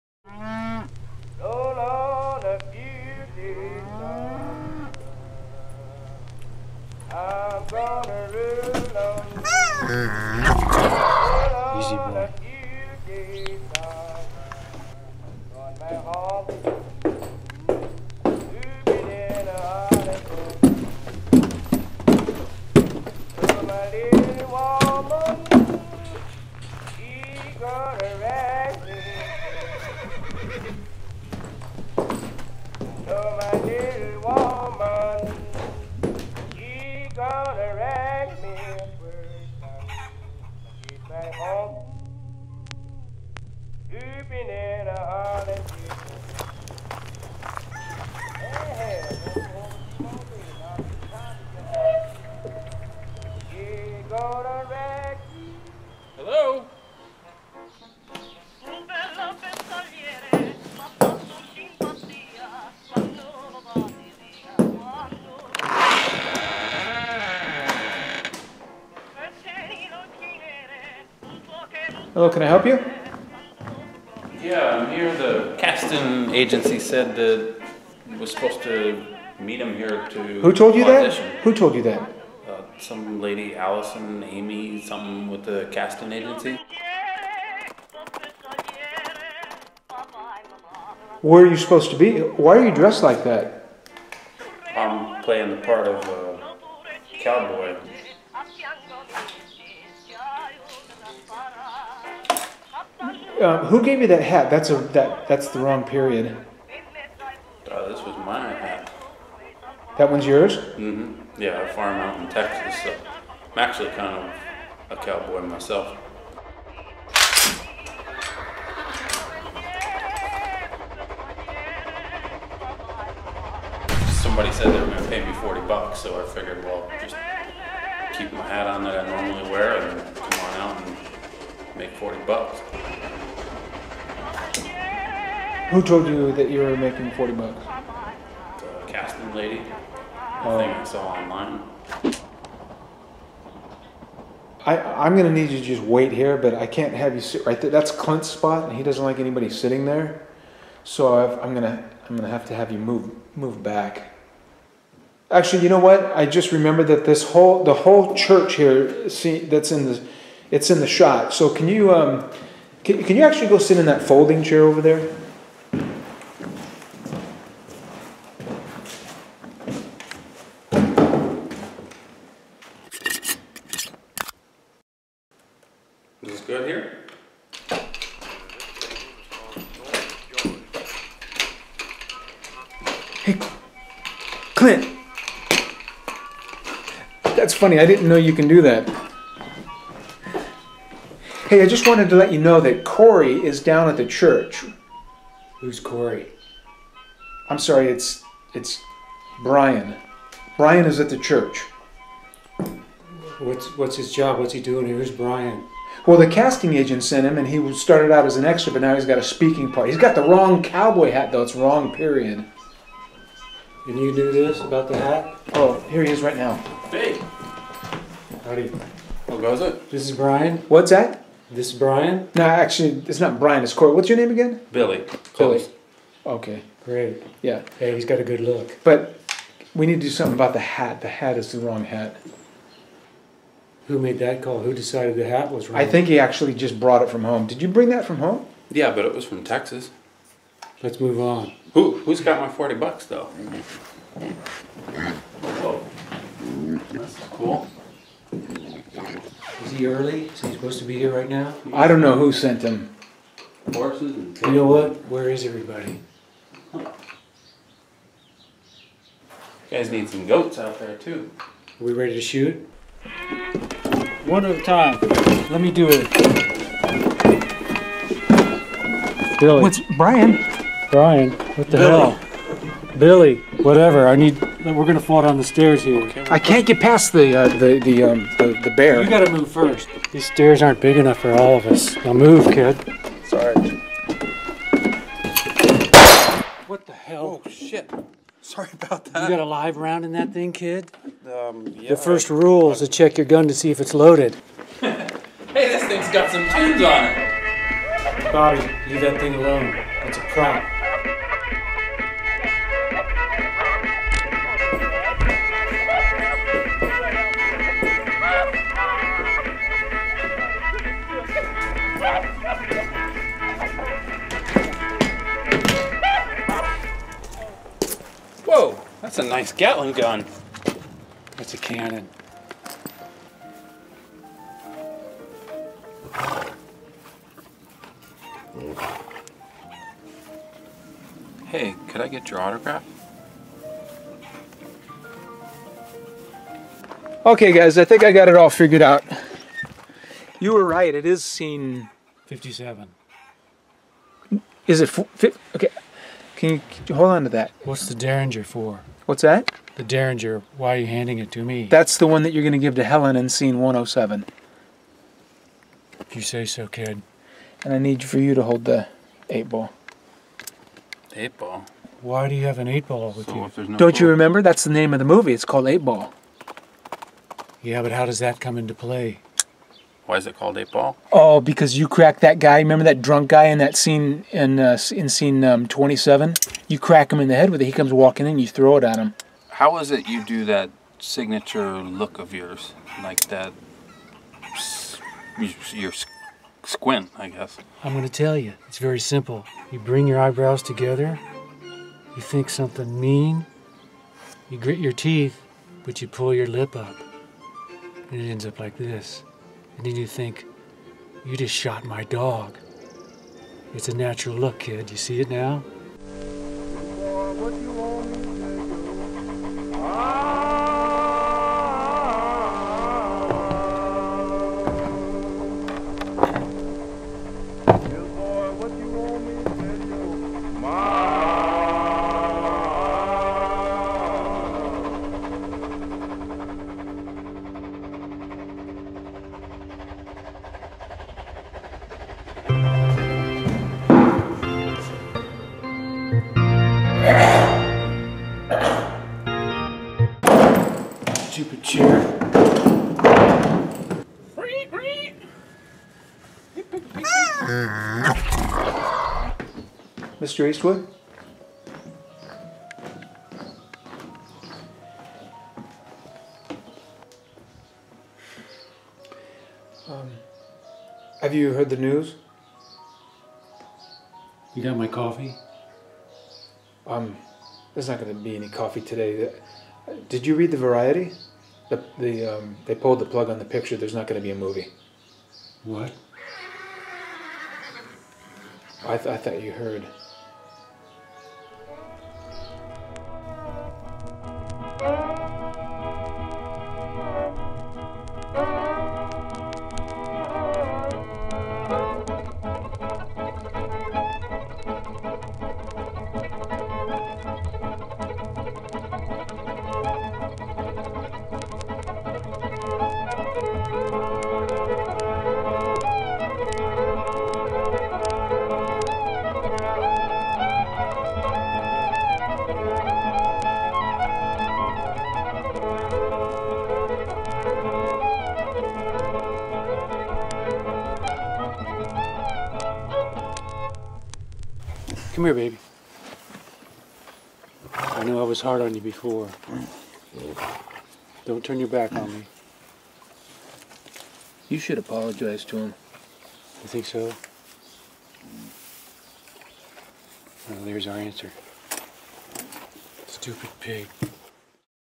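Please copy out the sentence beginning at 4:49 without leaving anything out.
You got a live round in that thing, kid?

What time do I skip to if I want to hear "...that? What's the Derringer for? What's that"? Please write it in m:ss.
5:47.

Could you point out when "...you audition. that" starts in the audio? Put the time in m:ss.
1:20.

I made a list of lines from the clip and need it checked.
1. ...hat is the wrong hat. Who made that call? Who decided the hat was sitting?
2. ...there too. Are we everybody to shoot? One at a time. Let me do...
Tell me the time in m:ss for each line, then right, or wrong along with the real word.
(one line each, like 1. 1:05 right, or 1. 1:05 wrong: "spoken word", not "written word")
1. 3:51 wrong: "wrong", not "sitting"
2. 4:20 wrong: "ready", not "everybody".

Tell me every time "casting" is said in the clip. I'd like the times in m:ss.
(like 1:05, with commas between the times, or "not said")
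1:15, 1:25, 2:18, 3:26.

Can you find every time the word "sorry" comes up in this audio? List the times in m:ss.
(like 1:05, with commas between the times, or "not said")
3:17, 4:43, 4:48.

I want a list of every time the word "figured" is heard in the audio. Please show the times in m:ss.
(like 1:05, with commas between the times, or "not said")
2:06, 5:38.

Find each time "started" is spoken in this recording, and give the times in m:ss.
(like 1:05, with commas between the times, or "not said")
3:27.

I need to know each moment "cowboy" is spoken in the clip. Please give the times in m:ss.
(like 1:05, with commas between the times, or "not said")
1:37, 1:55, 3:30.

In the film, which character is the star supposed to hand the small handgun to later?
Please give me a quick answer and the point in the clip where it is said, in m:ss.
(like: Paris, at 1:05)
Helen, at 5:52.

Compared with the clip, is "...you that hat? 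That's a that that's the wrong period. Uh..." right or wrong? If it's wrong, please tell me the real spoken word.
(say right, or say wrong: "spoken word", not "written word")
right.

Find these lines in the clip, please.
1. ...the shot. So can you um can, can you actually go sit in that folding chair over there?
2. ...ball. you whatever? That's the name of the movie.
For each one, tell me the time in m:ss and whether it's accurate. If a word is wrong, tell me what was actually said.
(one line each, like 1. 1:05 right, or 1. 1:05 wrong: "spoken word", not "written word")
1. 2:40 right
2. 6:03 wrong: "remember", not "whatever".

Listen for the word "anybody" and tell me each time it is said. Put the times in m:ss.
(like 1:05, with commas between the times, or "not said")
2:29.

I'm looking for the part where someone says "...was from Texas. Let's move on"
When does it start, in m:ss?
3:59.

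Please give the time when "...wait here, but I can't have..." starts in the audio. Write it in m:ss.
2:25.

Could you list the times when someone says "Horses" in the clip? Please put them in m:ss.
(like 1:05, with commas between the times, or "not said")
4:13.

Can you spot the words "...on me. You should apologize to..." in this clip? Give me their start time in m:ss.
8:51.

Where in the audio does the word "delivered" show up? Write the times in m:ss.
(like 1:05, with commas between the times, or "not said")
not said.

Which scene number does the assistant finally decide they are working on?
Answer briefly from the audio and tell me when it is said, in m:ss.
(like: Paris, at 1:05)
57, at 5:42.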